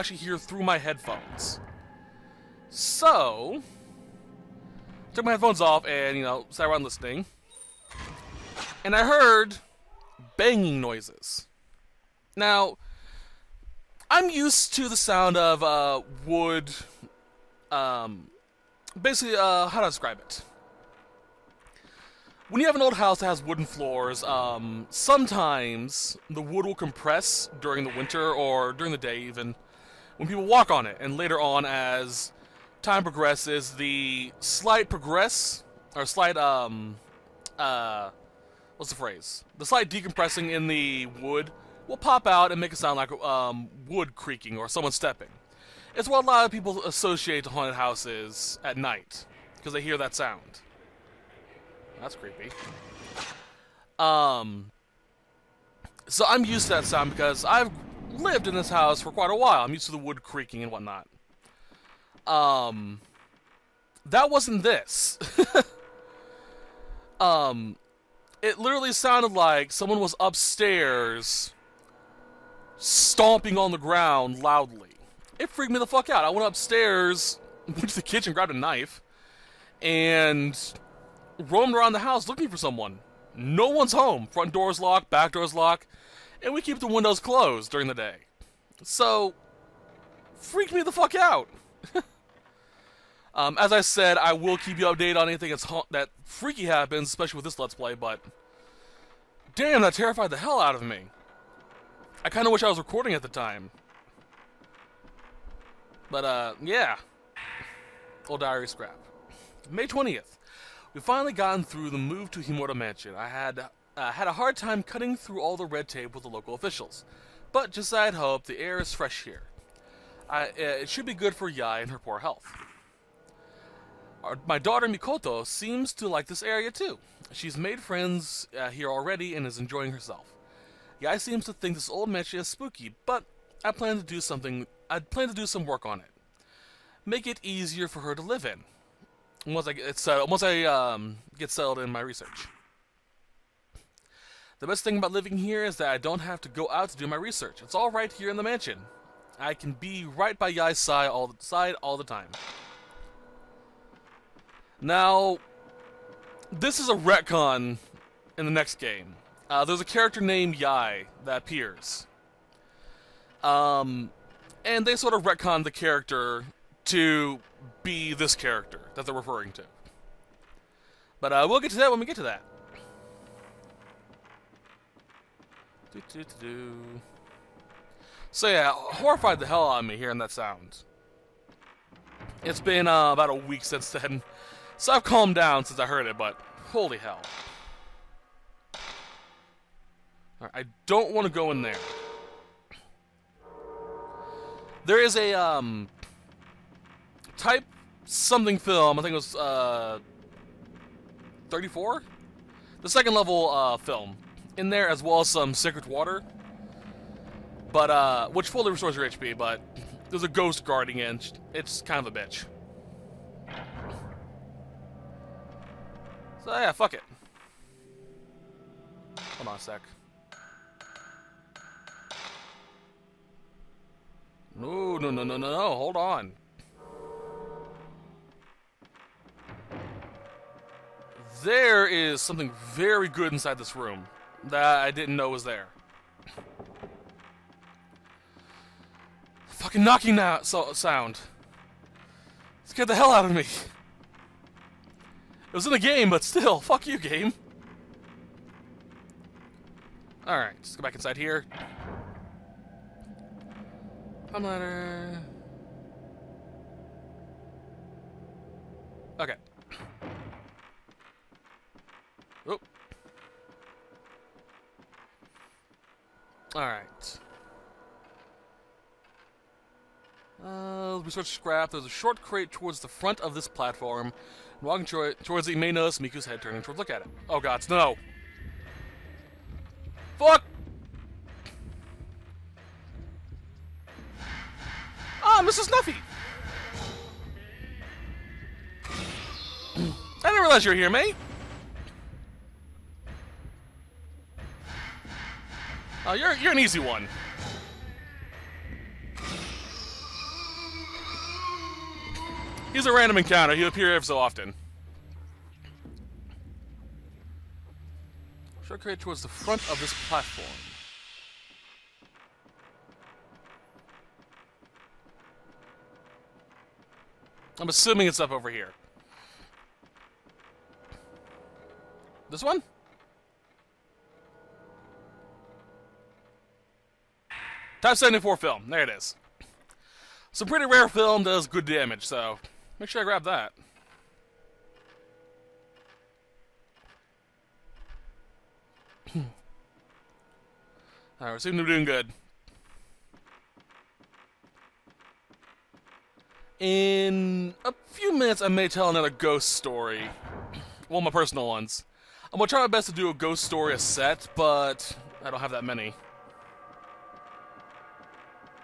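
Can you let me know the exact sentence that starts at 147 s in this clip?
It's all right here in the mansion.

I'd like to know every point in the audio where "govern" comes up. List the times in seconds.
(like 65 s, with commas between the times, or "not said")
not said.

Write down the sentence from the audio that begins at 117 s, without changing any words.
But just as I had hoped, the air is fresh here.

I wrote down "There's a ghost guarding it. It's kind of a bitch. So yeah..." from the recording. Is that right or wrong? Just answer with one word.
right.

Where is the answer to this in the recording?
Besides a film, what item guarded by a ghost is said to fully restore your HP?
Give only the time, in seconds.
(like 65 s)
205 s.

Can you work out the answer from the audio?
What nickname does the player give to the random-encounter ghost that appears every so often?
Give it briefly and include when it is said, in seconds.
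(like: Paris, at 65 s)
Snuffy, at 285 s.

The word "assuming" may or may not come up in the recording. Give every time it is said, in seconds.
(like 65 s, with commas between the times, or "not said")
317 s.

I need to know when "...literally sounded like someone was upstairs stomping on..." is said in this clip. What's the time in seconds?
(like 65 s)
68 s.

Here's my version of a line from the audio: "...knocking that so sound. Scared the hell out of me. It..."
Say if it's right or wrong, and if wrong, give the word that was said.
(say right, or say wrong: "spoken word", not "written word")
right.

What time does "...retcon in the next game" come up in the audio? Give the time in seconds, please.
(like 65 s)
156 s.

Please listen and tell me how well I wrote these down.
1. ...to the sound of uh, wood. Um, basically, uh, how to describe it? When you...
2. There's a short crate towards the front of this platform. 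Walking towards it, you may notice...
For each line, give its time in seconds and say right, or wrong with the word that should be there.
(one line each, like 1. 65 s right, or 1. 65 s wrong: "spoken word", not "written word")
1. 14 s right
2. 271 s right.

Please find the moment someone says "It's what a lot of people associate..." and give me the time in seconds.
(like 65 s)
45 s.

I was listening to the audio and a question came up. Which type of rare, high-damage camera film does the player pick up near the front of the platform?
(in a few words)
Type 74.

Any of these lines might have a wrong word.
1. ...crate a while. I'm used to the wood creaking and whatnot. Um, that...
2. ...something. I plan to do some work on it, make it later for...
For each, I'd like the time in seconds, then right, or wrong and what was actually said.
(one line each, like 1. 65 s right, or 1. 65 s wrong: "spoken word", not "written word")
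1. 59 s wrong: "quite", not "crate"
2. 134 s wrong: "easier", not "later".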